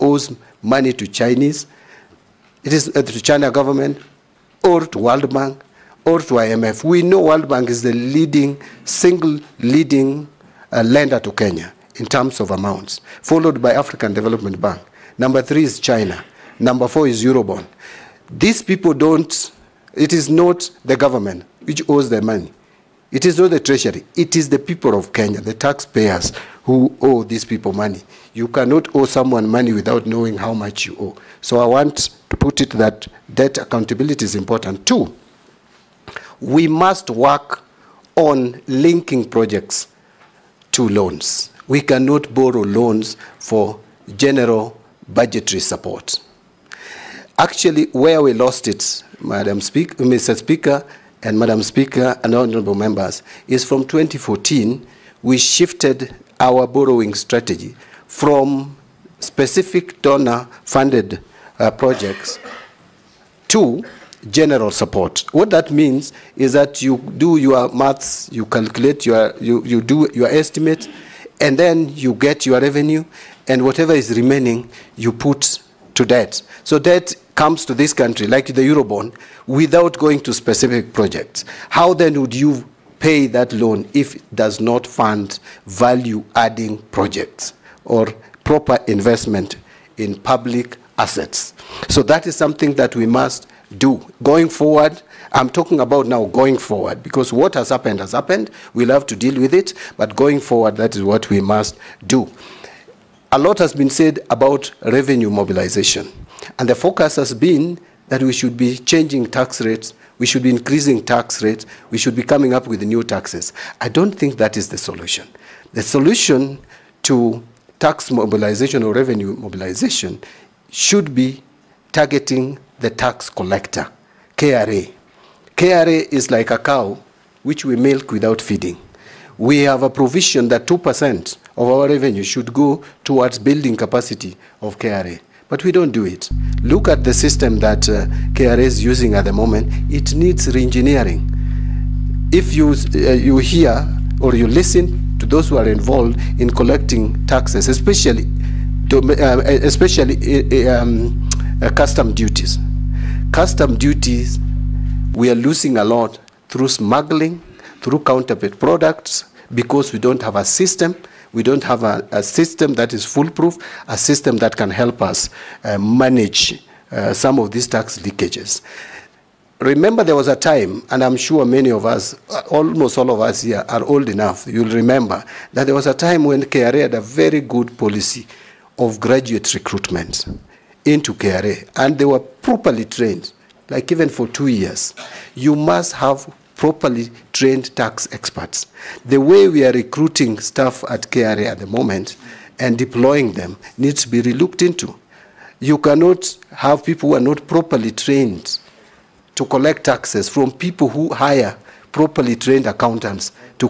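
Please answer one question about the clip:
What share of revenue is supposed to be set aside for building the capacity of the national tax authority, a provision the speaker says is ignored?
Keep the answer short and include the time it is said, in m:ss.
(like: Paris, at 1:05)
2%, at 2:10.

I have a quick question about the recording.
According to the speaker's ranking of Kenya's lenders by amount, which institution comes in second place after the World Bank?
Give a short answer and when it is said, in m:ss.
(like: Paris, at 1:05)
African Development Bank, at 0:13.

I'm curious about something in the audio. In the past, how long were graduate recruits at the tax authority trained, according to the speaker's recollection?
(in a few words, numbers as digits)
2 years.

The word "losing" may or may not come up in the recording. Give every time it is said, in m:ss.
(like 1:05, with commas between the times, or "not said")
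2:35.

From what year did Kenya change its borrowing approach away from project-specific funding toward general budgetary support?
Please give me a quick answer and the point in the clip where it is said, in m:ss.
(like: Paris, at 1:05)
2014, at 0:53.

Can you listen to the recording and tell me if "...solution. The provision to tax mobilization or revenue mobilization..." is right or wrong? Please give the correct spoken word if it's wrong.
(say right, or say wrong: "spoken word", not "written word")
wrong: "solution", not "provision".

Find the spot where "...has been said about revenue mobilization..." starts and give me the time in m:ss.
1:43.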